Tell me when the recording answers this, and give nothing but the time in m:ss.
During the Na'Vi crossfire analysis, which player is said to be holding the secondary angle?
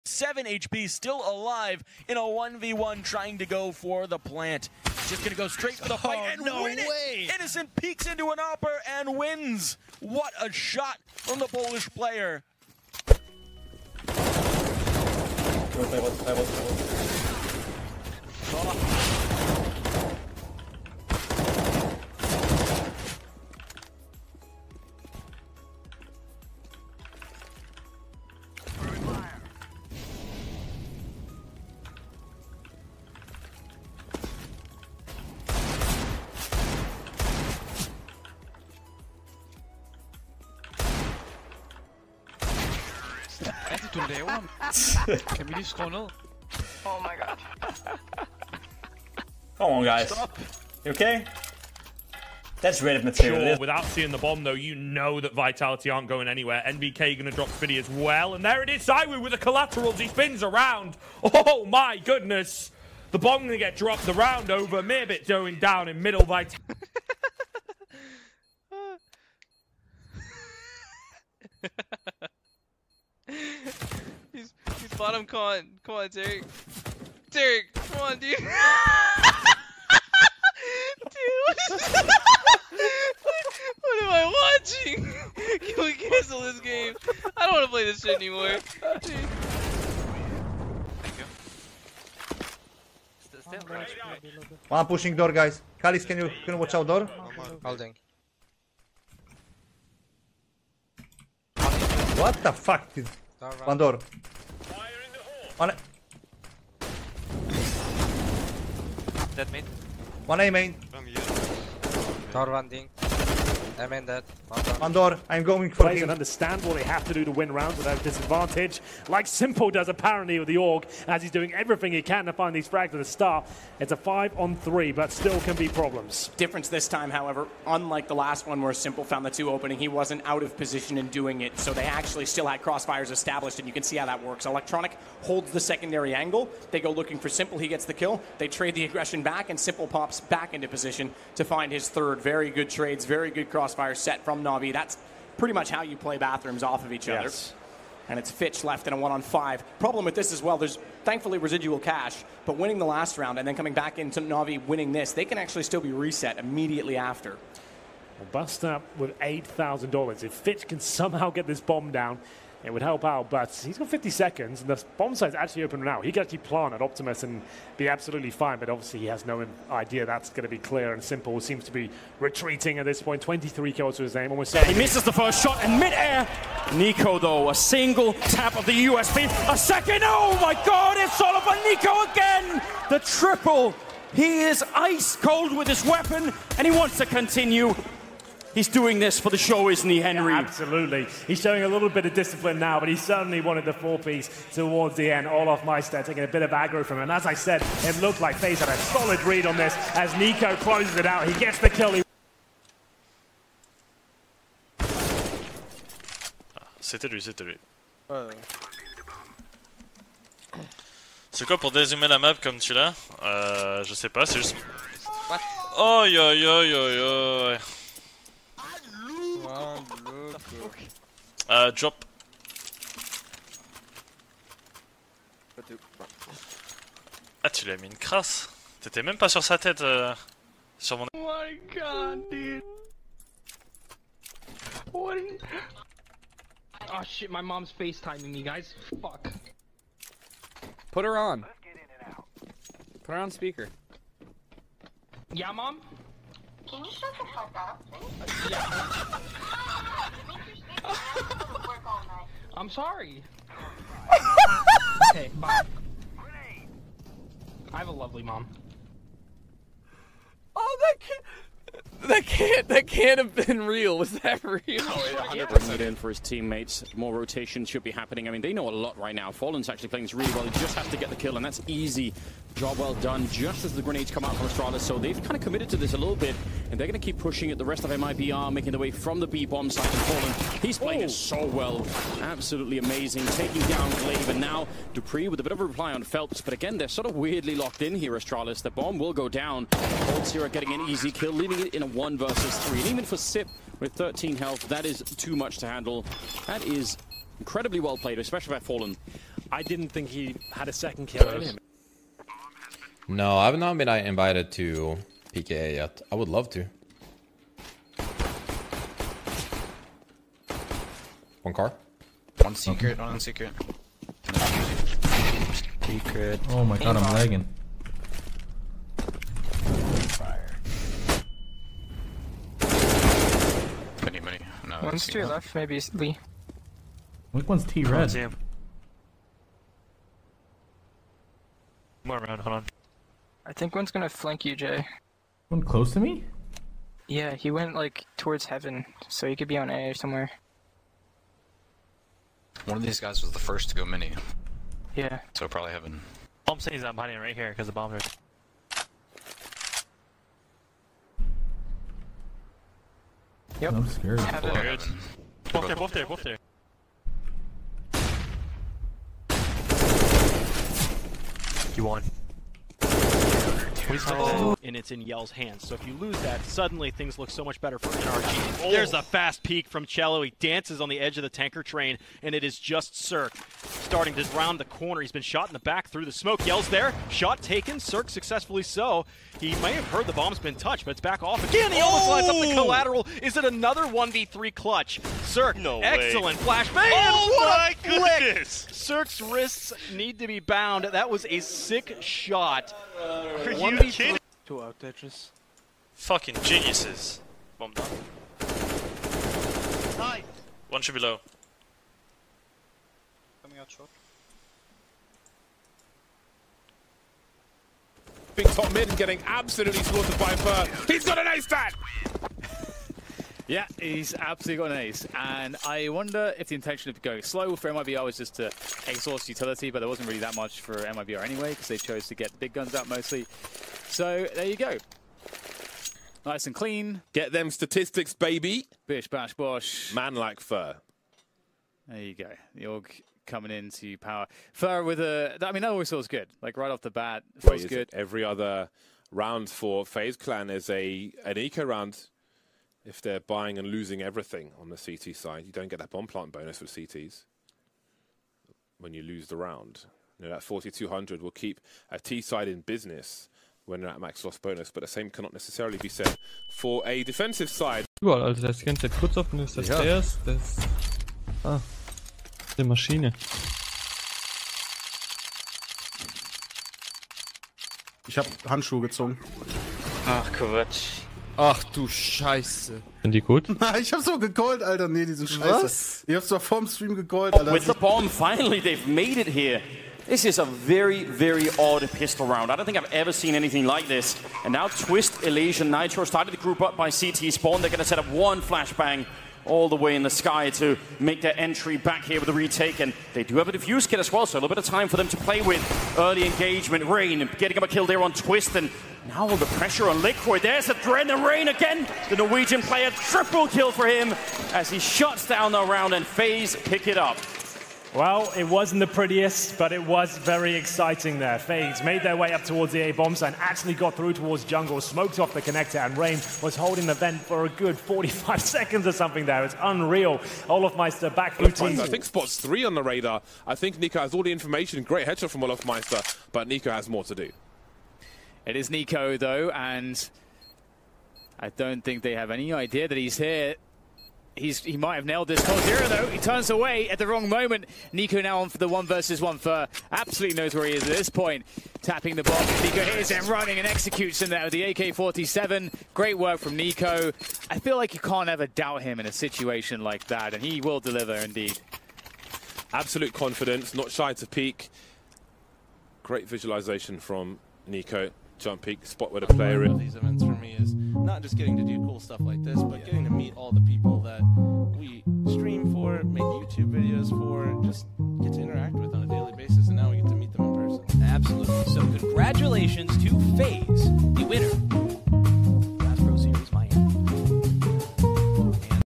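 2:14.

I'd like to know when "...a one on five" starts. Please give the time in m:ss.
2:28.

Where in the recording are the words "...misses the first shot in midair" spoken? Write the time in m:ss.
2:54.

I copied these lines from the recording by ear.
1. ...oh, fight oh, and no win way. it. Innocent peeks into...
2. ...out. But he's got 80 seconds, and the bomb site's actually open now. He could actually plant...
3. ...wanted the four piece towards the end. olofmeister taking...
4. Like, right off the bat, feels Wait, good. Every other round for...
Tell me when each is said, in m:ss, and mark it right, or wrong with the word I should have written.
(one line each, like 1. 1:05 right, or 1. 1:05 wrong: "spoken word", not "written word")
1. 0:05 right
2. 2:43 wrong: "50", not "80"
3. 3:13 right
4. 7:16 right.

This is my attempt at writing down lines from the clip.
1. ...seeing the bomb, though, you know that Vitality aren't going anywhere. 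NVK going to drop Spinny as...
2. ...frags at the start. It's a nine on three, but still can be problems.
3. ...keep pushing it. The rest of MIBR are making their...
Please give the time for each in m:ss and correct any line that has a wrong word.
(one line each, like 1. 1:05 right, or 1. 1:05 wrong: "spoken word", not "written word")
1. 0:53 right
2. 2:02 wrong: "five", not "nine"
3. 4:37 right.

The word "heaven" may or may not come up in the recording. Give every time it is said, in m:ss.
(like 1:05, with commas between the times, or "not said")
5:38, 5:45.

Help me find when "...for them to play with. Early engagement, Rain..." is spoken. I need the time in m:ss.
8:14.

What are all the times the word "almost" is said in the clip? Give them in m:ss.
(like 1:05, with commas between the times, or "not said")
2:54, 6:21.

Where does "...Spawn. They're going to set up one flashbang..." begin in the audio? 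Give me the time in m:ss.
8:07.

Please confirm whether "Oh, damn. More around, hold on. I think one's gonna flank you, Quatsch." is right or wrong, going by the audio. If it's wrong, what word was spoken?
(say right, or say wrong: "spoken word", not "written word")
wrong: "Jay", not "Quatsch".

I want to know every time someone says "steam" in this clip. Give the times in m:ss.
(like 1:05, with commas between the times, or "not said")
not said.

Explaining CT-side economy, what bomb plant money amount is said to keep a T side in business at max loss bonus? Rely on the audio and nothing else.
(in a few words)
4,200.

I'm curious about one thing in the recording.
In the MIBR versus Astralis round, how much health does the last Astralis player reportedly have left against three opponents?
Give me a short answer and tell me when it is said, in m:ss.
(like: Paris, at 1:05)
13, at 4:53.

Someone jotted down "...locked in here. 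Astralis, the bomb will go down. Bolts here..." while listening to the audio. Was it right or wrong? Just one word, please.
right.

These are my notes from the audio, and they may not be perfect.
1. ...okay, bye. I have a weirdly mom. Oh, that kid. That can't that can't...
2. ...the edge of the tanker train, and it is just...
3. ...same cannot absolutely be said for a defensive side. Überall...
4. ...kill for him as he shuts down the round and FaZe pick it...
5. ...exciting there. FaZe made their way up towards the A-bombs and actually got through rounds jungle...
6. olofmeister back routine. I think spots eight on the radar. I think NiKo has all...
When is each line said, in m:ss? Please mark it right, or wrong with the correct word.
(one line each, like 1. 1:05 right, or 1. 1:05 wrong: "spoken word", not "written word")
1. 4:15 wrong: "lovely", not "weirdly"
2. 6:10 right
3. 7:34 wrong: "necessarily", not "absolutely"
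4. 8:23 right
5. 8:30 wrong: "towards", not "rounds"
6. 8:40 wrong: "three", not "eight".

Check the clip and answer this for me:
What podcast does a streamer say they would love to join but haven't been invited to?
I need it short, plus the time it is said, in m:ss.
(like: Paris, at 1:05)
PKA, at 5:05.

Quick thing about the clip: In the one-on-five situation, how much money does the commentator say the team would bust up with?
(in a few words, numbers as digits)
$8,000.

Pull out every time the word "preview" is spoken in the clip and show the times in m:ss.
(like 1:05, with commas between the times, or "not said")
not said.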